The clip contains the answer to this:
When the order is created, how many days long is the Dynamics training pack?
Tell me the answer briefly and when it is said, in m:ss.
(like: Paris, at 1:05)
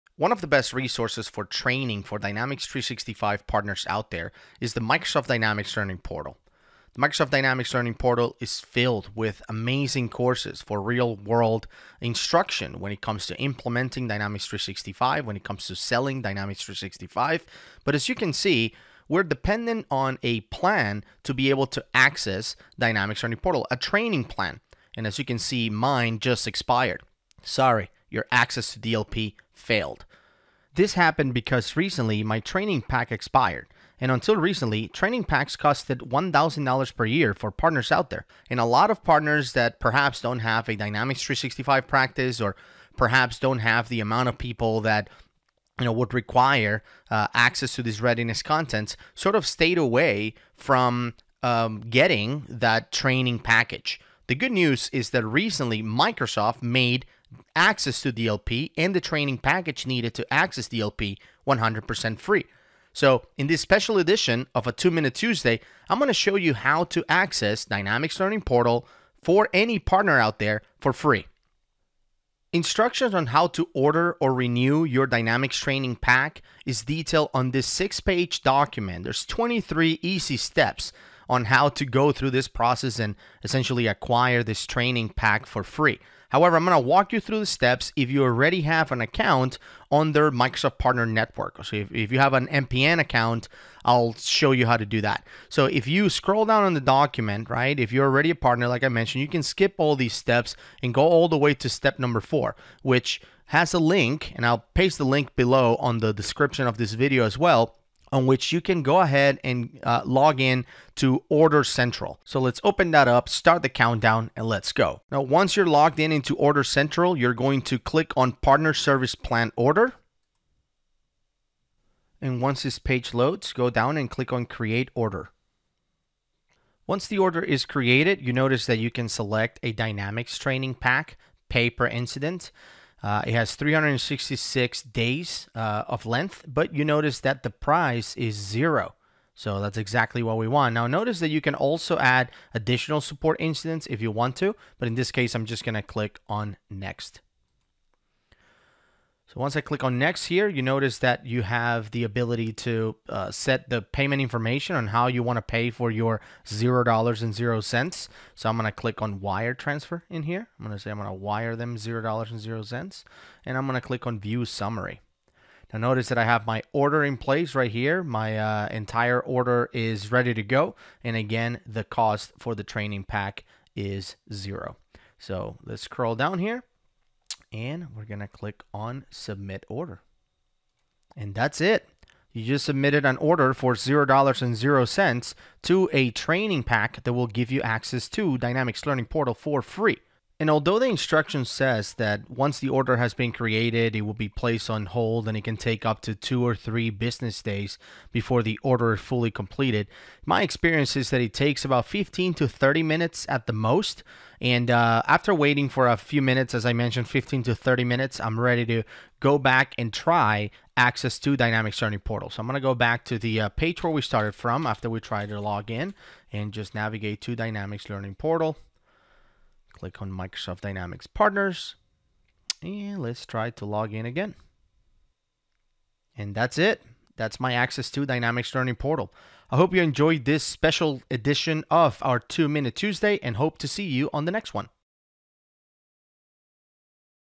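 366, at 2:13.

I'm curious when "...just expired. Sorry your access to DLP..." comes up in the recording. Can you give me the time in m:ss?
0:26.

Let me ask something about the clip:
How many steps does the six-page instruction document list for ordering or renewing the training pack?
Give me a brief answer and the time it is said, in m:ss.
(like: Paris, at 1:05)
23, at 1:19.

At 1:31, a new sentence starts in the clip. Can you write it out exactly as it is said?
So if, if you have an MPN account, I'll show you how to do that.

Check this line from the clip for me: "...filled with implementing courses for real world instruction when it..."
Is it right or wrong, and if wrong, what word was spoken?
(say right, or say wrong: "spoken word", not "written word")
wrong: "amazing", not "implementing".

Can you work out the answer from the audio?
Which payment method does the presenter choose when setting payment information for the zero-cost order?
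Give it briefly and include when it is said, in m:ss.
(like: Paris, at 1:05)
Wire transfer, at 2:39.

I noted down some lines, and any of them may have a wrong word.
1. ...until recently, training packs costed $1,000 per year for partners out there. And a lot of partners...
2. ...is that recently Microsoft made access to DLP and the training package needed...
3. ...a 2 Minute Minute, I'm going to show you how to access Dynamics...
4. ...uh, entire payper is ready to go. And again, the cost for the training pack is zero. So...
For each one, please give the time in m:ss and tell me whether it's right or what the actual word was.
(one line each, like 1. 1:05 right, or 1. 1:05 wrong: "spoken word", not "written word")
1. 0:34 right
2. 0:54 right
3. 1:04 wrong: "Tuesday", not "Minute"
4. 2:48 wrong: "order", not "payper".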